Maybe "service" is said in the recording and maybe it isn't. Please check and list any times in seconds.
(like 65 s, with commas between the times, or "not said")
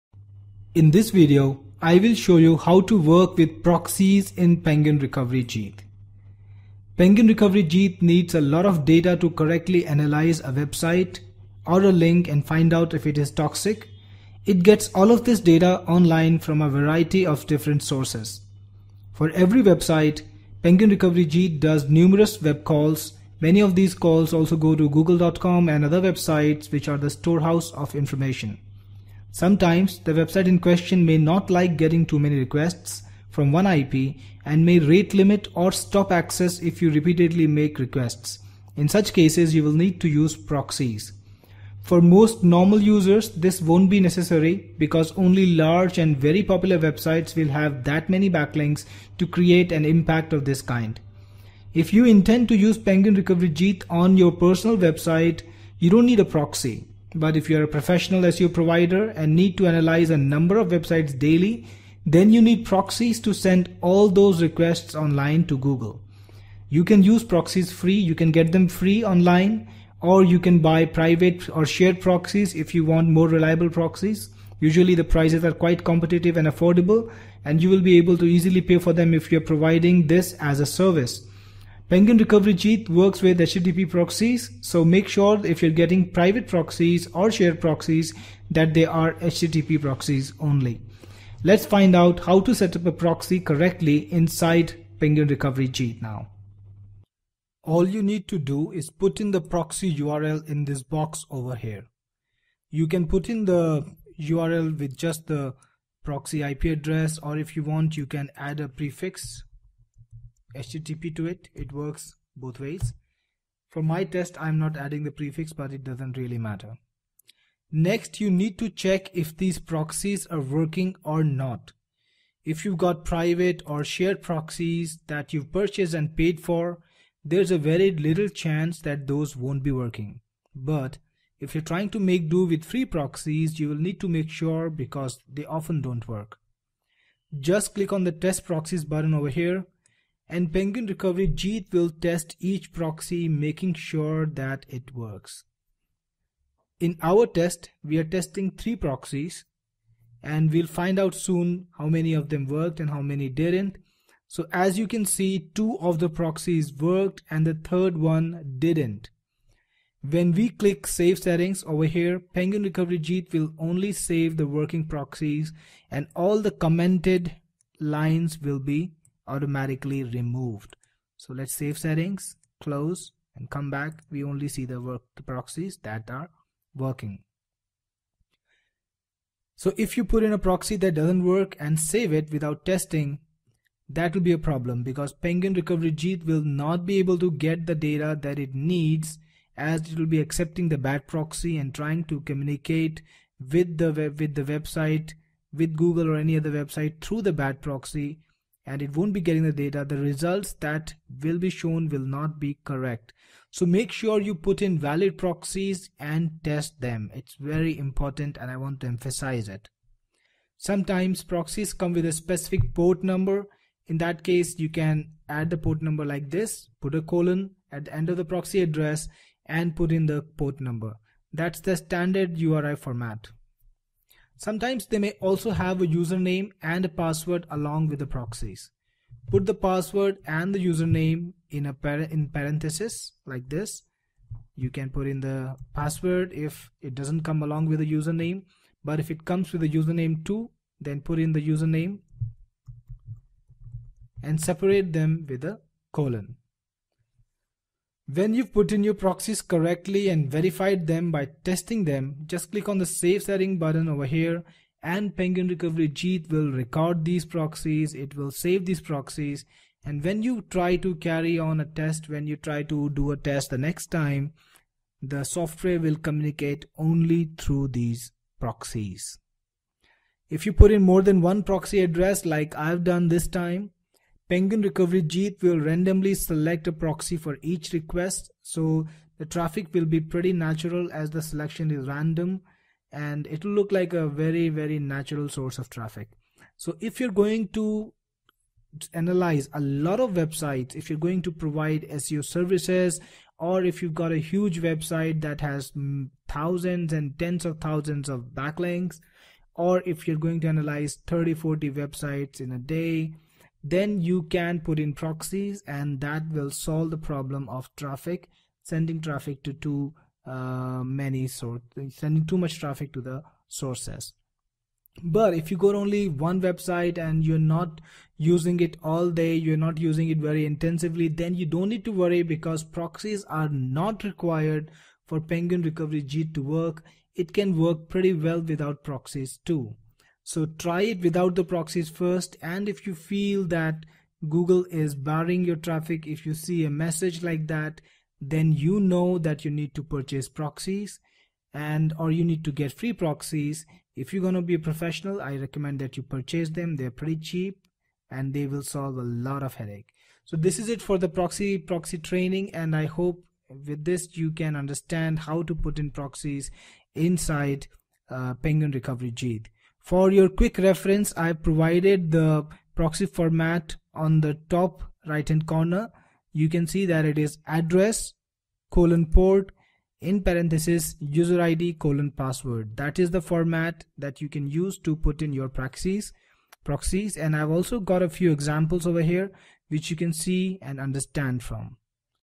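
80 s, 292 s.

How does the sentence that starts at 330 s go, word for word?
So try it without the proxies first.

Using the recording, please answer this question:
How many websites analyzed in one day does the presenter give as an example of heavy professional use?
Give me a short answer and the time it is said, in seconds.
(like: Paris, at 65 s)
30 to 40, at 301 s.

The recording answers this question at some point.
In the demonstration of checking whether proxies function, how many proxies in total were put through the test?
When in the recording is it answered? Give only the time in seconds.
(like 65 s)
148 s.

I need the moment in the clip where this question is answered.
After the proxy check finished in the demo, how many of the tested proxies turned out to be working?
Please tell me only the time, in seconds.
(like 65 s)
155 s.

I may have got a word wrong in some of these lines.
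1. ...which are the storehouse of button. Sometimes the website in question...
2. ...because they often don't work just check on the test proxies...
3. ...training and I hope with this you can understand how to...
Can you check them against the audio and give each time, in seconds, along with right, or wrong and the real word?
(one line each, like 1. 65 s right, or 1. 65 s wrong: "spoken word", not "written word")
1. 26 s wrong: "information", not "button"
2. 134 s wrong: "click", not "check"
3. 351 s right.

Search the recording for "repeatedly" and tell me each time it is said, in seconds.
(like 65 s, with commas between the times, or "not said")
36 s.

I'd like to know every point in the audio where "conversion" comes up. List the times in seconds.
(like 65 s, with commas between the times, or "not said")
not said.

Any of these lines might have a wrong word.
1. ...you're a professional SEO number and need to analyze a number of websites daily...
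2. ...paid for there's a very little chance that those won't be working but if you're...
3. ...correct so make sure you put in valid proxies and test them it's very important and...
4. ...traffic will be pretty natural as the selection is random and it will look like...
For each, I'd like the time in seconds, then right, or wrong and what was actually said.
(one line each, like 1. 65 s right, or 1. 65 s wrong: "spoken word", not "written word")
1. 57 s wrong: "provider", not "number"
2. 126 s right
3. 202 s right
4. 279 s right.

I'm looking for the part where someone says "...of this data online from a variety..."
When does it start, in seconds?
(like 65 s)
15 s.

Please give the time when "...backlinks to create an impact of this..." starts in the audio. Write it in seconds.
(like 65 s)
48 s.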